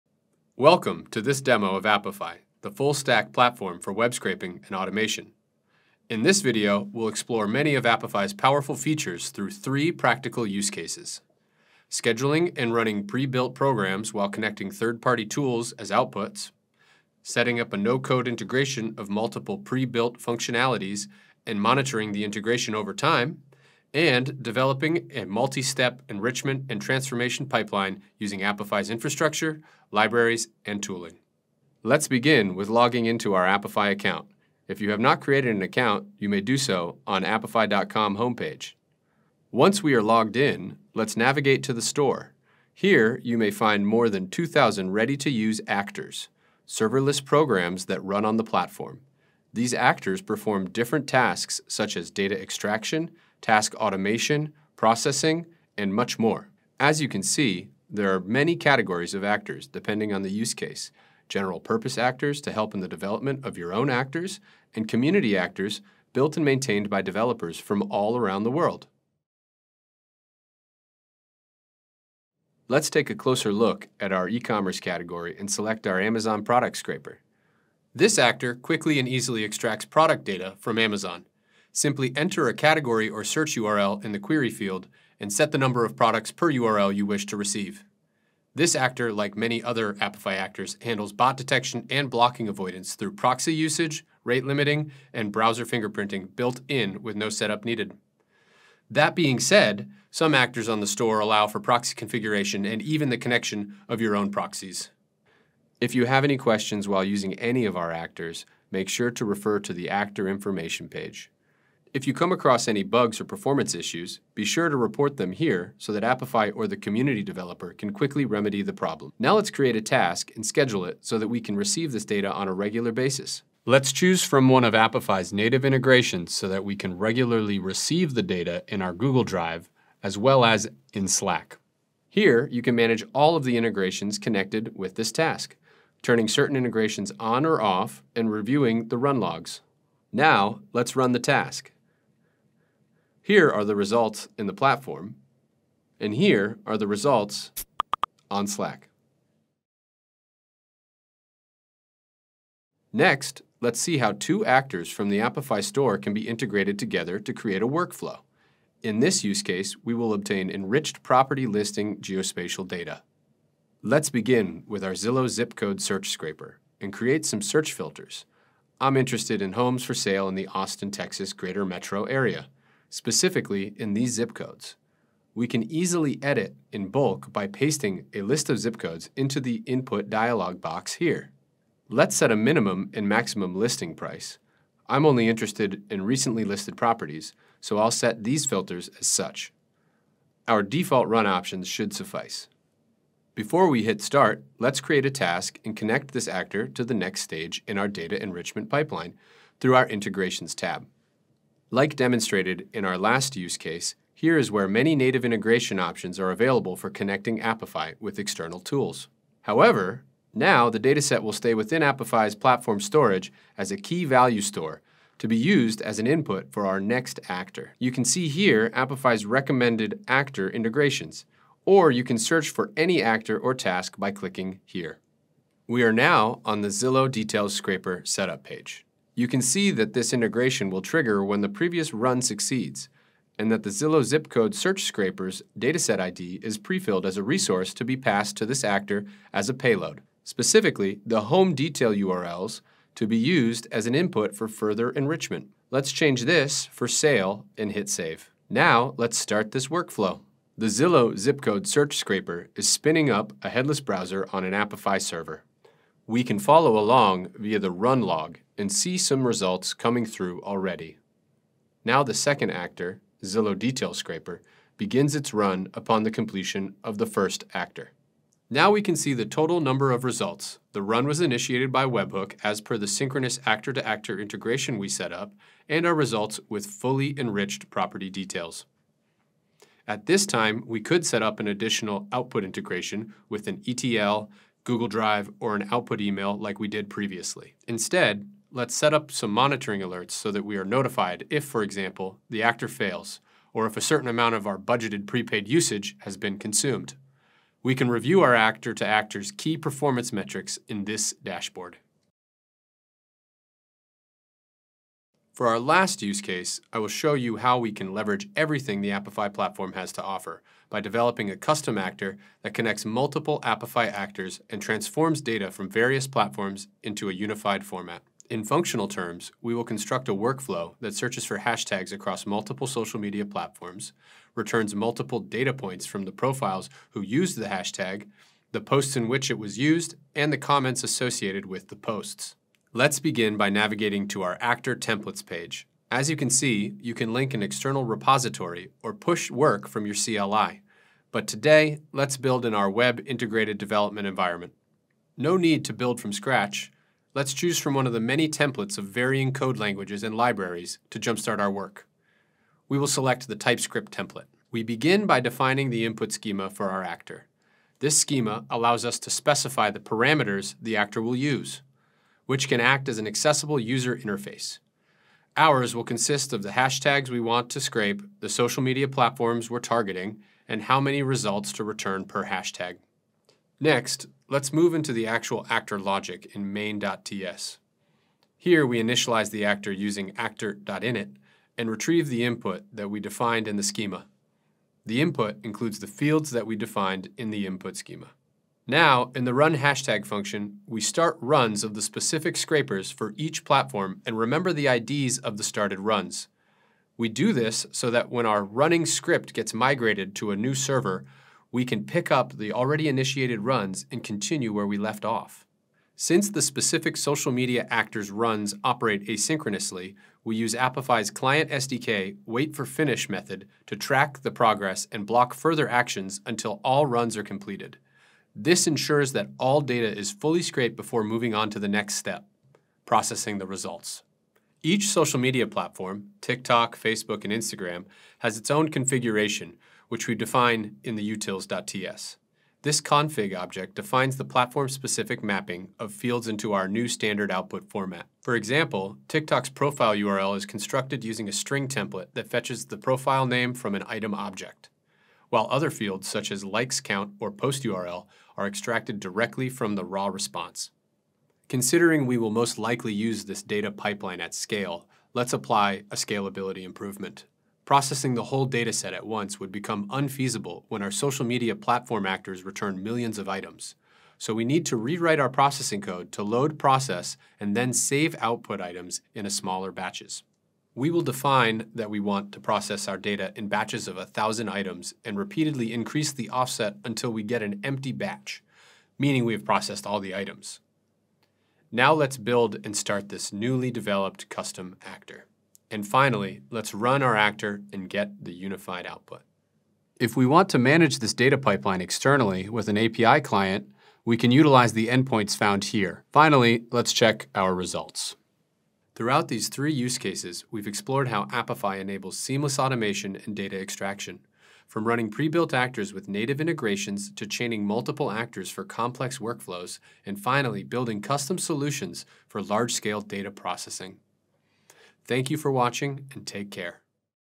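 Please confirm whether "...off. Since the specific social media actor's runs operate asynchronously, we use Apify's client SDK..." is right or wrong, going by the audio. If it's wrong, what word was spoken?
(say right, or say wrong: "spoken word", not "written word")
right.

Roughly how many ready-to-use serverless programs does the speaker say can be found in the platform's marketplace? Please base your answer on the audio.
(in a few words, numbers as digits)
2,000.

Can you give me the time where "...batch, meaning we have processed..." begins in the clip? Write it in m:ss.
7:57.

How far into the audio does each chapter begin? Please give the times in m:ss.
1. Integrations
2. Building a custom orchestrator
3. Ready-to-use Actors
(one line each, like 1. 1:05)
1. 2:30
2. 5:02
3. 1:10.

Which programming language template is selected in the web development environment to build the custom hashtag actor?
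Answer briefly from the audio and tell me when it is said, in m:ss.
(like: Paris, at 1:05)
TypeScript, at 5:53.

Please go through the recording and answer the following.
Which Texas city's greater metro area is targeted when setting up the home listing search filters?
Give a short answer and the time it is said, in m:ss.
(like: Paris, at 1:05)
Austin, at 2:50.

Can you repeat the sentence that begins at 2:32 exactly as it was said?
Next, let's see how two actors from the Apify store can be integrated together to create a workflow.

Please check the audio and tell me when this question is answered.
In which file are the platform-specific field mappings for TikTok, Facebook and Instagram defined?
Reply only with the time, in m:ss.
7:11.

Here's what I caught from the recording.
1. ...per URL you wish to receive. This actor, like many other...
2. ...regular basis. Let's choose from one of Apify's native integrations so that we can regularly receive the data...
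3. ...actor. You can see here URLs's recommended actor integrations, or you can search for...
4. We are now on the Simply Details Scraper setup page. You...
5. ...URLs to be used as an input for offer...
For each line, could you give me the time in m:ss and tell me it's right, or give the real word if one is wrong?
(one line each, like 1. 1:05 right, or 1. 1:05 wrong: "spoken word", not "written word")
1. 1:26 right
2. 2:02 right
3. 3:37 wrong: "Apify", not "URLs"
4. 3:45 wrong: "Zillow", not "Simply"
5. 4:01 wrong: "further", not "offer".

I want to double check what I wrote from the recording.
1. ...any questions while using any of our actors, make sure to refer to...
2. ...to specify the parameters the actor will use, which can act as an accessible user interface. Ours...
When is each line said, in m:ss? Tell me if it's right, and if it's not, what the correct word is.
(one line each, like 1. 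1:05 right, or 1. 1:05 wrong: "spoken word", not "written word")
1. 1:46 right
2. 5:58 right.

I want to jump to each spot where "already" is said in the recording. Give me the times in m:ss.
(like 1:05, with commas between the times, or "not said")
4:20, 6:42.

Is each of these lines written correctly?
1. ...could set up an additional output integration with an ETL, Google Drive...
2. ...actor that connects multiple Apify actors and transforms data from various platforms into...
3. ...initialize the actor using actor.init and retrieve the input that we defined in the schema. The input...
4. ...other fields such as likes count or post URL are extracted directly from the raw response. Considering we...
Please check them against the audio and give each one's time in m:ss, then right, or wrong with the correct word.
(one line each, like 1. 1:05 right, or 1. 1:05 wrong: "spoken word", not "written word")
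1. 4:40 right
2. 5:11 right
3. 6:18 right
4. 7:25 right.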